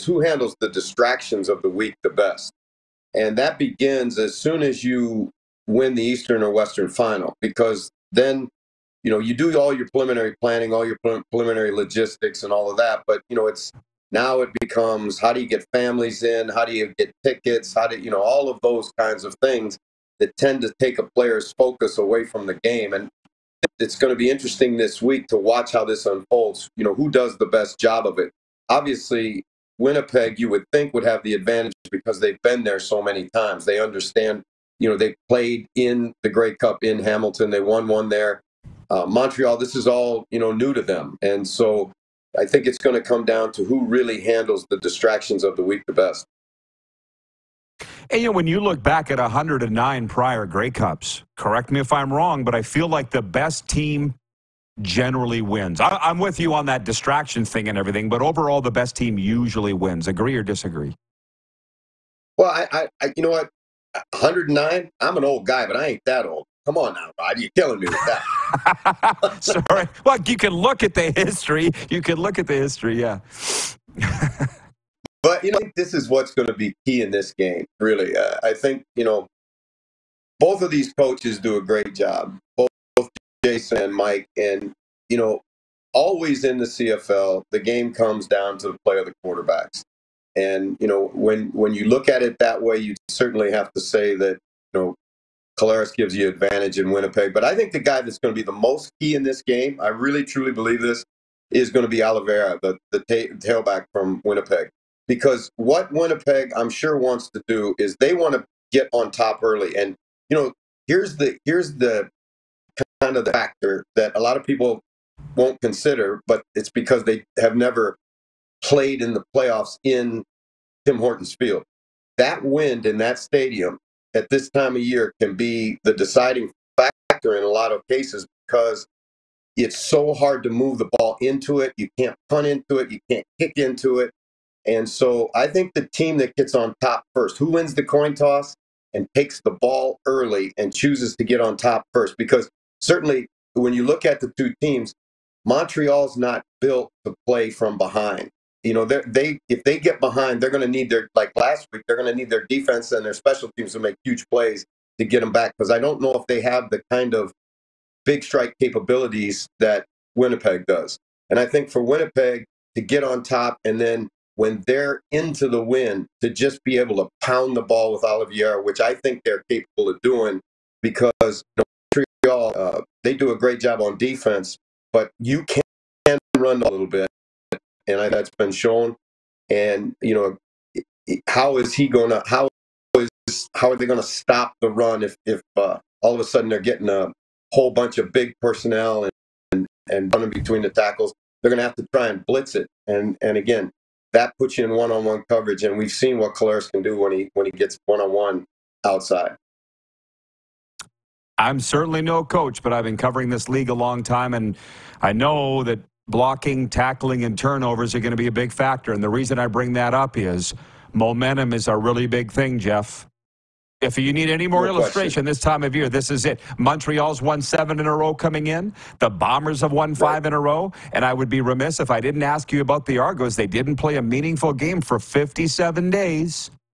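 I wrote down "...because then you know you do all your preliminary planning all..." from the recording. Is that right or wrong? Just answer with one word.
right.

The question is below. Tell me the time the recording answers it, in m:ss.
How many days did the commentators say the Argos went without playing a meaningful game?
3:44.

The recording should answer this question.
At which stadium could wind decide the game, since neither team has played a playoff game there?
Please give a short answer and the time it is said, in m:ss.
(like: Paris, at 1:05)
Tim Hortons Field, at 2:00.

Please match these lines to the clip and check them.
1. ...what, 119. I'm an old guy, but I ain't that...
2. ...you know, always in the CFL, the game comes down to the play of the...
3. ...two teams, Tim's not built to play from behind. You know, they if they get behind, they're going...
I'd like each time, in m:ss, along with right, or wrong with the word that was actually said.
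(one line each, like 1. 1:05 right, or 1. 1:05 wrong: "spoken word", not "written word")
1. 1:03 wrong: "109", not "119"
2. 1:25 right
3. 2:24 wrong: "Montreal", not "Tim".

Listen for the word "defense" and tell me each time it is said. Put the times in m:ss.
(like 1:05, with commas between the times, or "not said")
2:32, 2:53.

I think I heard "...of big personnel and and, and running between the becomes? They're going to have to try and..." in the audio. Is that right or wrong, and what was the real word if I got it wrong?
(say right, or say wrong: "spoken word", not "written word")
wrong: "tackles", not "becomes".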